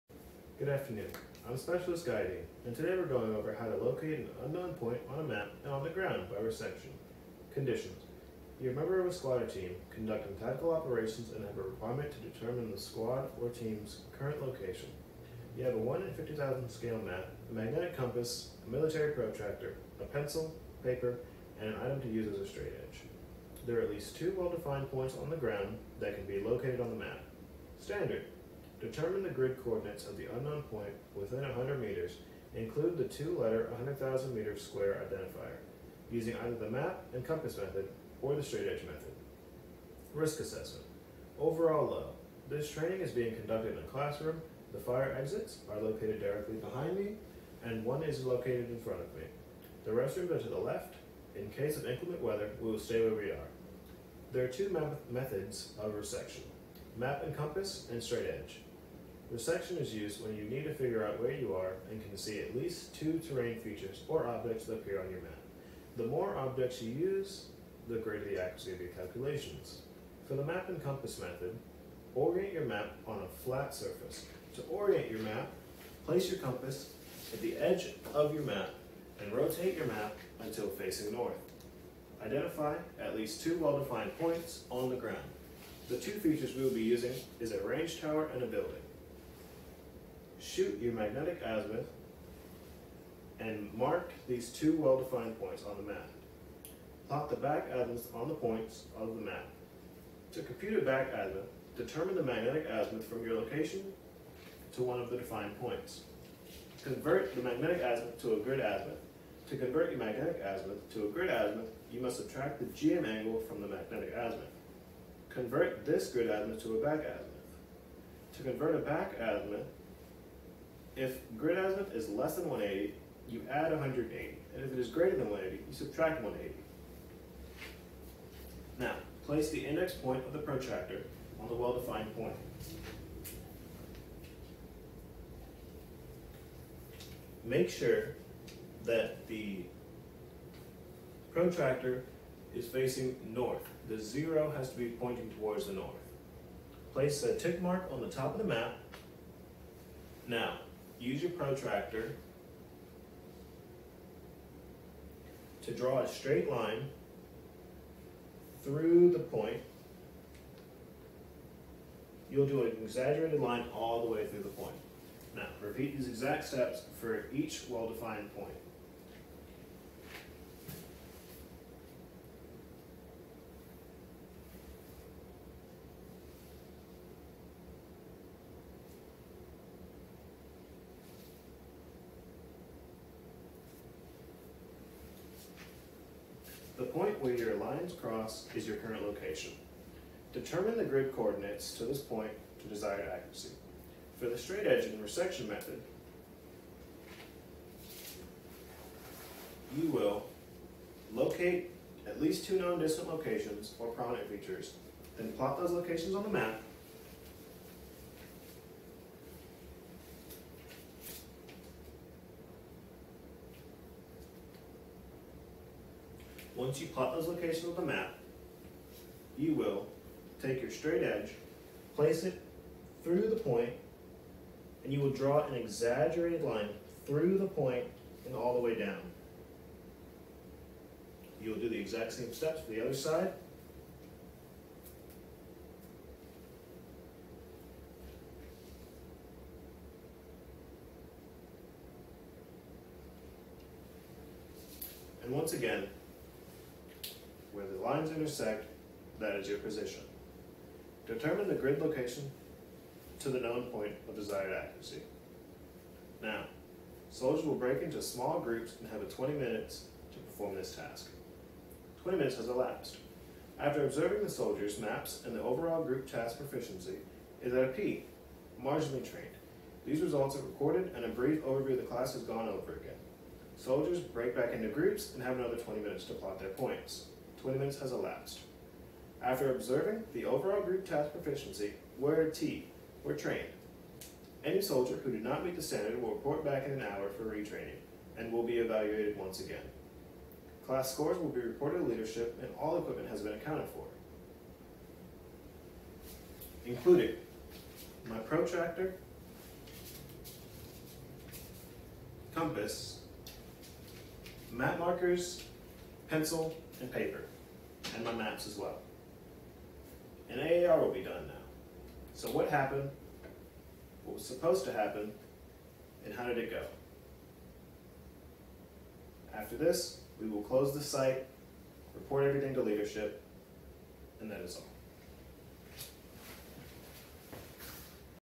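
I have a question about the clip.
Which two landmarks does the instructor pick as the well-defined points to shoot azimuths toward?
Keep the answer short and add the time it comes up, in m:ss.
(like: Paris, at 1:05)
A range tower and a building, at 1:27.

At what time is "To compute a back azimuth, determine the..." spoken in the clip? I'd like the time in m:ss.
1:40.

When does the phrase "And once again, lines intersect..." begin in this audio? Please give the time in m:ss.
4:05.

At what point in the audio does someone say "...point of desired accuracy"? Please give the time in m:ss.
4:13.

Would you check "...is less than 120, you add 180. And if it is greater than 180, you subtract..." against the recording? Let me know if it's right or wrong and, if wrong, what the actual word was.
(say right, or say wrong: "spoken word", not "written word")
wrong: "180", not "120".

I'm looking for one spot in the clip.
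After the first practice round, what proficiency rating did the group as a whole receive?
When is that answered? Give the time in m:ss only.
4:27.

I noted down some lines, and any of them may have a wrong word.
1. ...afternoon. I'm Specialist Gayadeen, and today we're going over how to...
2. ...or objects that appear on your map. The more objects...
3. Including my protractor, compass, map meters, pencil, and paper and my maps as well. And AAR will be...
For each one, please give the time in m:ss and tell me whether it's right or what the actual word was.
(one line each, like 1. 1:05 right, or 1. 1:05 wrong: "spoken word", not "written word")
1. 0:00 right
2. 1:04 right
3. 4:56 wrong: "markers", not "meters".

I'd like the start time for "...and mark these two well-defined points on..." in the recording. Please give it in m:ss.
1:33.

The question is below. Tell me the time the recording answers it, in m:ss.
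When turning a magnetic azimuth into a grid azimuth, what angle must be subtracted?
1:52.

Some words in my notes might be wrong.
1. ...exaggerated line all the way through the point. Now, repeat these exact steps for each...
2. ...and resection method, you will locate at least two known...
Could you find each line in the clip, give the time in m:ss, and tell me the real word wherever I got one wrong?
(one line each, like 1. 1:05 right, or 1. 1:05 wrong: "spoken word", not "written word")
1. 2:42 right
2. 3:14 right.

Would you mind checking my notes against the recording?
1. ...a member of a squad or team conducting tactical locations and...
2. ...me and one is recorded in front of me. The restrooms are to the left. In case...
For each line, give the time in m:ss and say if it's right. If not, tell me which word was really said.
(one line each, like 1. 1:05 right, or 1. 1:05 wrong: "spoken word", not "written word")
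1. 0:08 wrong: "operations", not "locations"
2. 0:46 wrong: "located", not "recorded".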